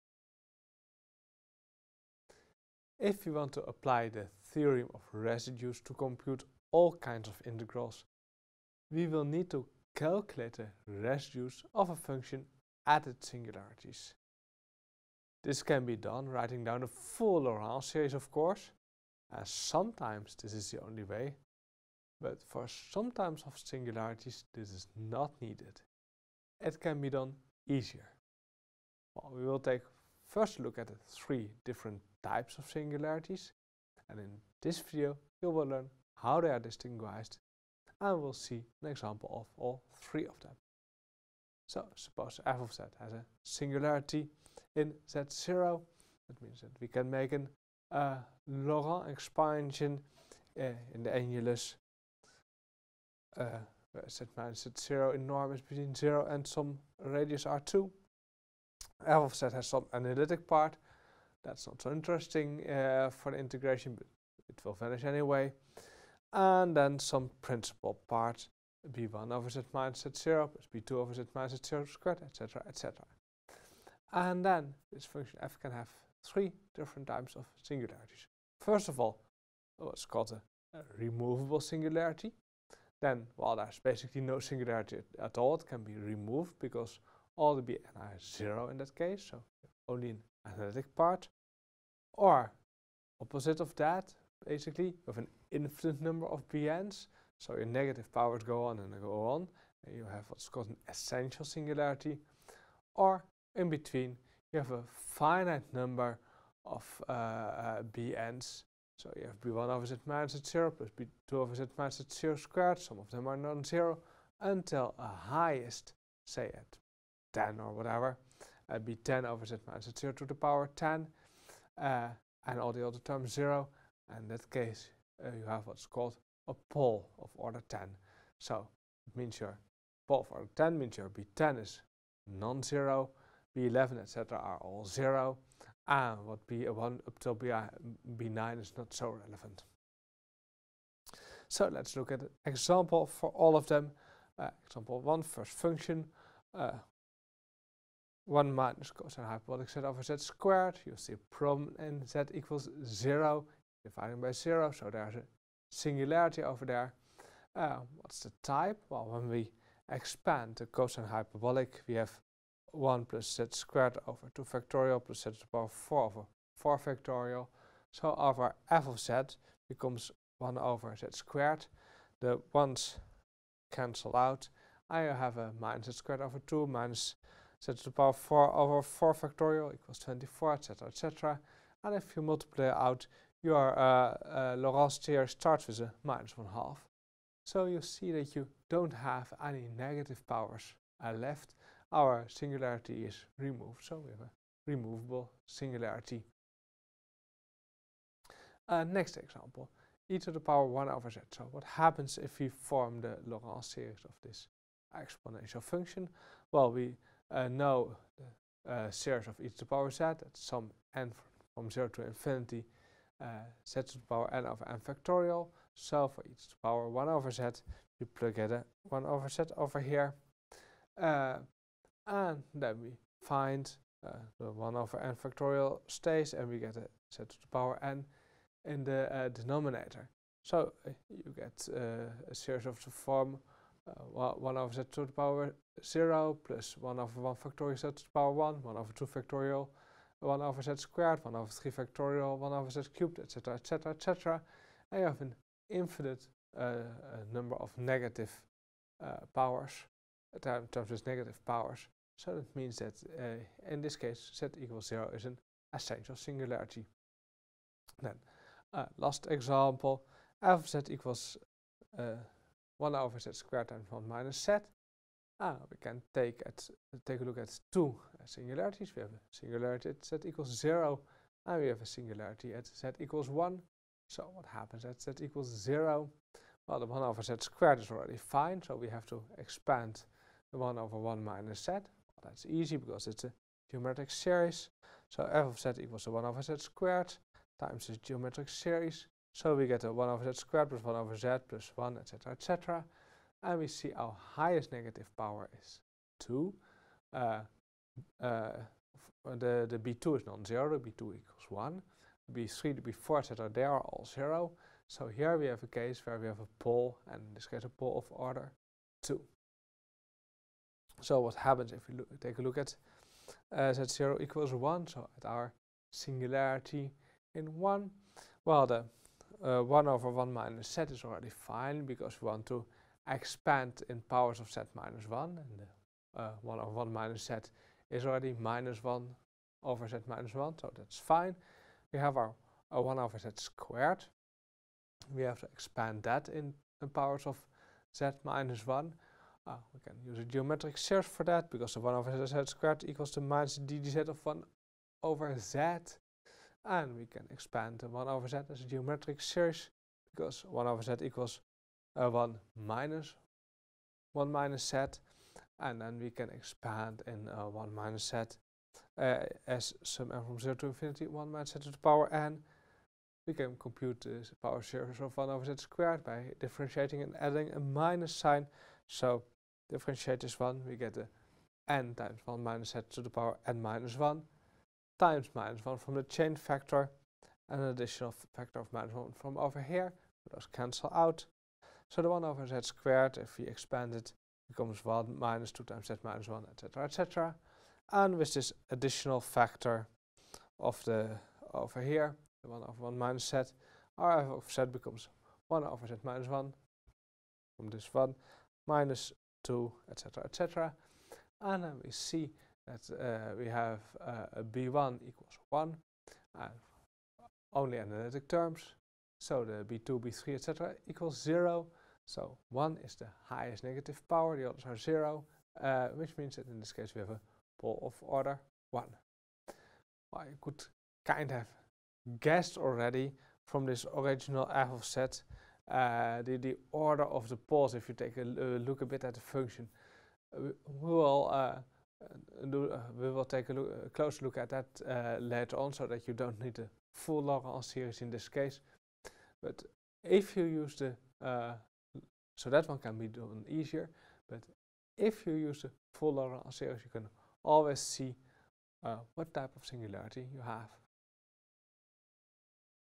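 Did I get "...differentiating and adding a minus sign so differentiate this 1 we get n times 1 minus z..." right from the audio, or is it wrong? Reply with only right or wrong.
right.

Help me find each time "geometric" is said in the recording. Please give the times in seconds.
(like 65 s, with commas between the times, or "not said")
283 s, 287 s, 340 s, 348 s.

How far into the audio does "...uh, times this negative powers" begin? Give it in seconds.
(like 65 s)
250 s.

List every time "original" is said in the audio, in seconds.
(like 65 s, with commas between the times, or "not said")
423 s.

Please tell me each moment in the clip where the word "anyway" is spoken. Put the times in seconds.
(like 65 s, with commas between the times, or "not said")
65 s.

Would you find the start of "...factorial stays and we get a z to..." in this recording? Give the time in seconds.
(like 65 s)
225 s.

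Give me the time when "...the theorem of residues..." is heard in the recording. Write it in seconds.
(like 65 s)
4 s.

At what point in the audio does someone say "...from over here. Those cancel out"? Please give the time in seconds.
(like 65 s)
379 s.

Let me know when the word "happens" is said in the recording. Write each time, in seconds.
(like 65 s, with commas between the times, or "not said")
201 s, 274 s, 311 s.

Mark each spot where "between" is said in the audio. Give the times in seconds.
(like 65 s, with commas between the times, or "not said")
55 s, 103 s.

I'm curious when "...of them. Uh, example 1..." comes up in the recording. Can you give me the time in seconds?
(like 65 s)
143 s.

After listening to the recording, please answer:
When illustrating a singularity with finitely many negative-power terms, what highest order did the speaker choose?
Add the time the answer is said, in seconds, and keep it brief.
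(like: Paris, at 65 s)
10, at 126 s.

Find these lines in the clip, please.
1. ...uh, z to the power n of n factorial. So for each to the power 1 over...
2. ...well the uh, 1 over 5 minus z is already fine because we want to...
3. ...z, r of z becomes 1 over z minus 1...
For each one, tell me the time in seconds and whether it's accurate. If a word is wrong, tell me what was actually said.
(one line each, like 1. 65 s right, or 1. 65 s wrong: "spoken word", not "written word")
1. 213 s right
2. 318 s wrong: "1", not "5"
3. 393 s right.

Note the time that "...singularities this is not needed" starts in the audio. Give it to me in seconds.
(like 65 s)
23 s.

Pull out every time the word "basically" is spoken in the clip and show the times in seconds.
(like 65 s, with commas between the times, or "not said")
83 s, 94 s.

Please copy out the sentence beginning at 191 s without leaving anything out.
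Our singularity is removed, so we have a removable singularity.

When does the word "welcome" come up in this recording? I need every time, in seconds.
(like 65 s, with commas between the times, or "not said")
not said.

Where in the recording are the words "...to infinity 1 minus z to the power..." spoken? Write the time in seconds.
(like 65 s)
360 s.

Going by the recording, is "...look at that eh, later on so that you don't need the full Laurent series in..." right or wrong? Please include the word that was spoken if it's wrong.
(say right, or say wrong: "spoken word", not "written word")
right.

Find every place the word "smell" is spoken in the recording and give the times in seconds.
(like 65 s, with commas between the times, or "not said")
not said.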